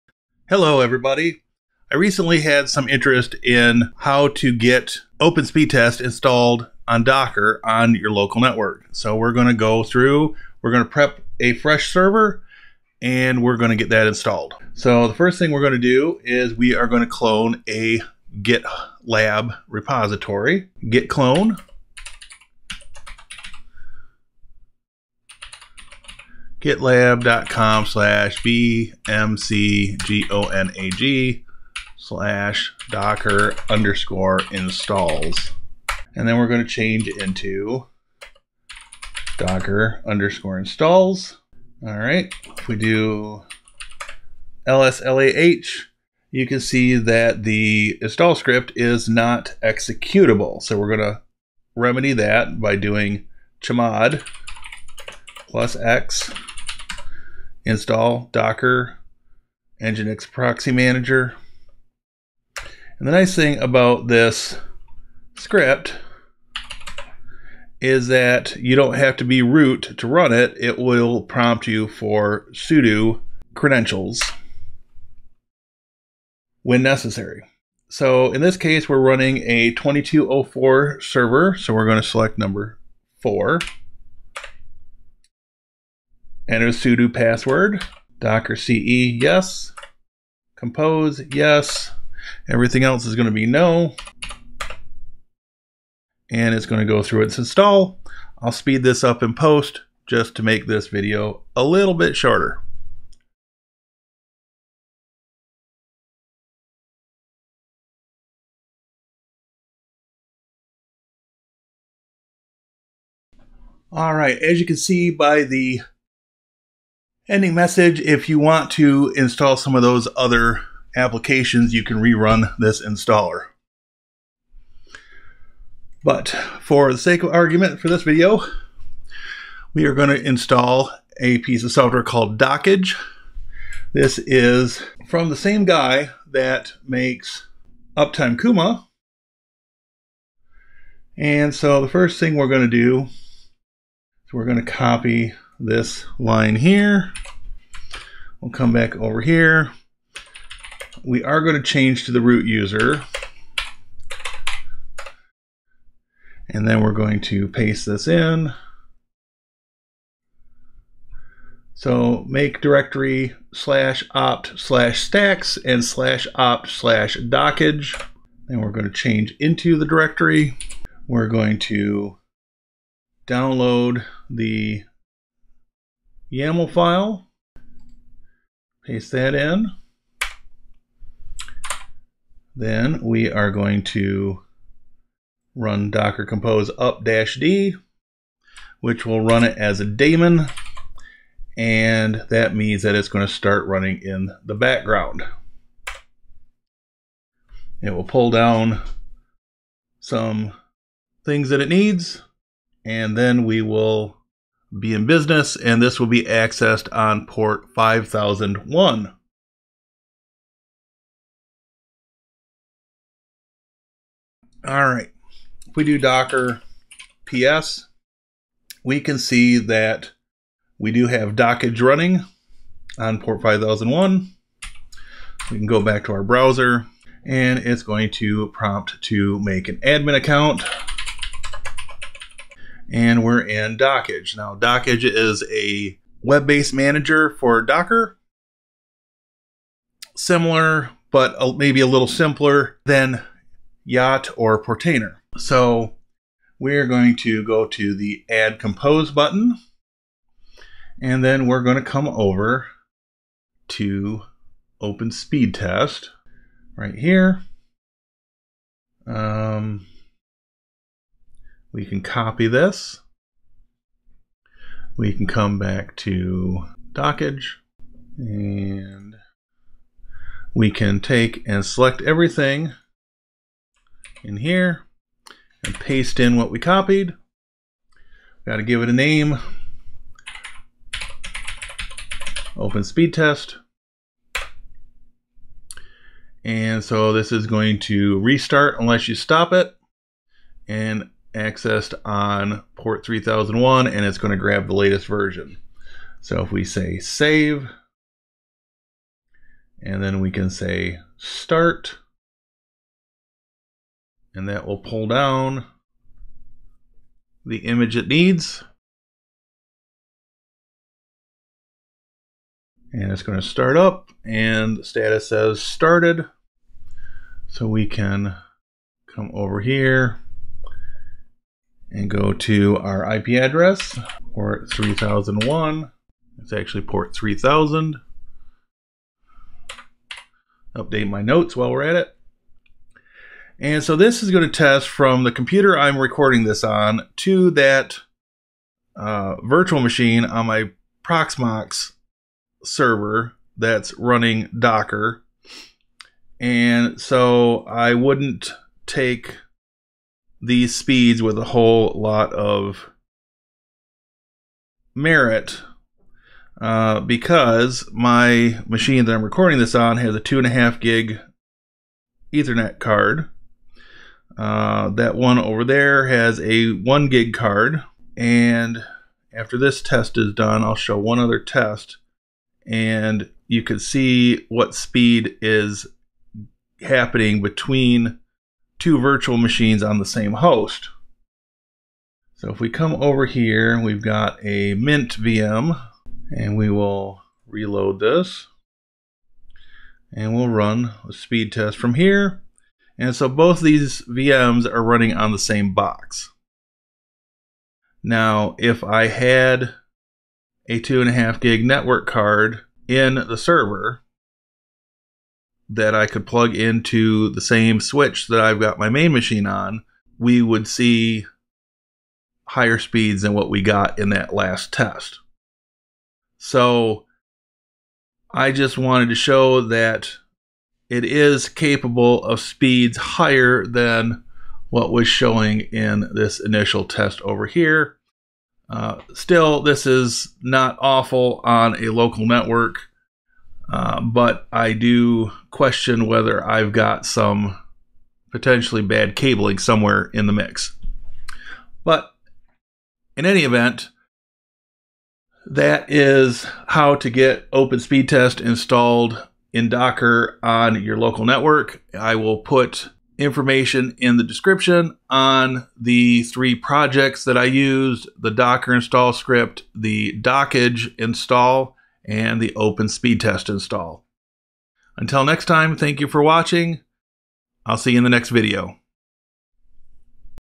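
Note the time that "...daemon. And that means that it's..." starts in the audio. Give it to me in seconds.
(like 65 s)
189 s.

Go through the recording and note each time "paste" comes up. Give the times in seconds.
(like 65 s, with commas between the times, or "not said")
157 s, 178 s, 275 s.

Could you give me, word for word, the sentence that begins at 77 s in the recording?
So in this case, we're running a 2204 server.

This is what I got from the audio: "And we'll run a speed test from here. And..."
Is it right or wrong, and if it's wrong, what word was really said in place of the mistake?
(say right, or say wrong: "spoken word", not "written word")
right.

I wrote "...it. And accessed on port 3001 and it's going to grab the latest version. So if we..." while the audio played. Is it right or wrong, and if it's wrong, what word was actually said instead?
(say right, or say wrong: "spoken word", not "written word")
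right.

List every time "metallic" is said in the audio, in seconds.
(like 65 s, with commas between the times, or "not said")
not said.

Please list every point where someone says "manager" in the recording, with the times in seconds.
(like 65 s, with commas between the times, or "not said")
60 s, 236 s.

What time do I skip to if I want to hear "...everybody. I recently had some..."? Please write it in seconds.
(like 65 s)
0 s.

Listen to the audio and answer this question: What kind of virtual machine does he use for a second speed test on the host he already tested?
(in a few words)
Mint VM.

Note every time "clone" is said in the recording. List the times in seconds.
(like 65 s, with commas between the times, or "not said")
17 s, 21 s.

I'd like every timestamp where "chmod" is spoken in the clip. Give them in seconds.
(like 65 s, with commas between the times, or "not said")
53 s.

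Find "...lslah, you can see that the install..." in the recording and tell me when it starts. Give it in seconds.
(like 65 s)
44 s.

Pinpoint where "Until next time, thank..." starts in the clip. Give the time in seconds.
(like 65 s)
464 s.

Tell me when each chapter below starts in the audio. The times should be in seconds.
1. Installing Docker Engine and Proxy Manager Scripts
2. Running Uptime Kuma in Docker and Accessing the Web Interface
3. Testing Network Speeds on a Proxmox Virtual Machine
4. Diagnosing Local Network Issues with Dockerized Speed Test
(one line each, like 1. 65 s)
1. 95 s
2. 190 s
3. 292 s
4. 390 s.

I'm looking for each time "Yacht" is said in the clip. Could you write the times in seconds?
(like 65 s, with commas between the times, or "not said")
243 s.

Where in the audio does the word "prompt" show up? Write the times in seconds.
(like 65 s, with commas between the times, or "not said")
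71 s, 228 s.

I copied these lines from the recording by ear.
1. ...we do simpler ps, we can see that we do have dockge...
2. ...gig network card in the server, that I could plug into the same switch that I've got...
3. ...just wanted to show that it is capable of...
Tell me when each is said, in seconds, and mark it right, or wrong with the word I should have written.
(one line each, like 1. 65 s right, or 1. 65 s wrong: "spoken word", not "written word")
1. 215 s wrong: "docker", not "simpler"
2. 401 s right
3. 418 s right.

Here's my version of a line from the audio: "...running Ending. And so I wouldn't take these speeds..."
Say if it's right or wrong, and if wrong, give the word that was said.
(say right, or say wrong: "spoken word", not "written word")
wrong: "Docker", not "Ending".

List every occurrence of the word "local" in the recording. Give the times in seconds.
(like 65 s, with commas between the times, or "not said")
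8 s, 431 s, 450 s.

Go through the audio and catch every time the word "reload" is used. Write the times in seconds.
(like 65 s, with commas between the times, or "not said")
387 s.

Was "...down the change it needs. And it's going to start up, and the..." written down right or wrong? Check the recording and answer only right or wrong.
wrong.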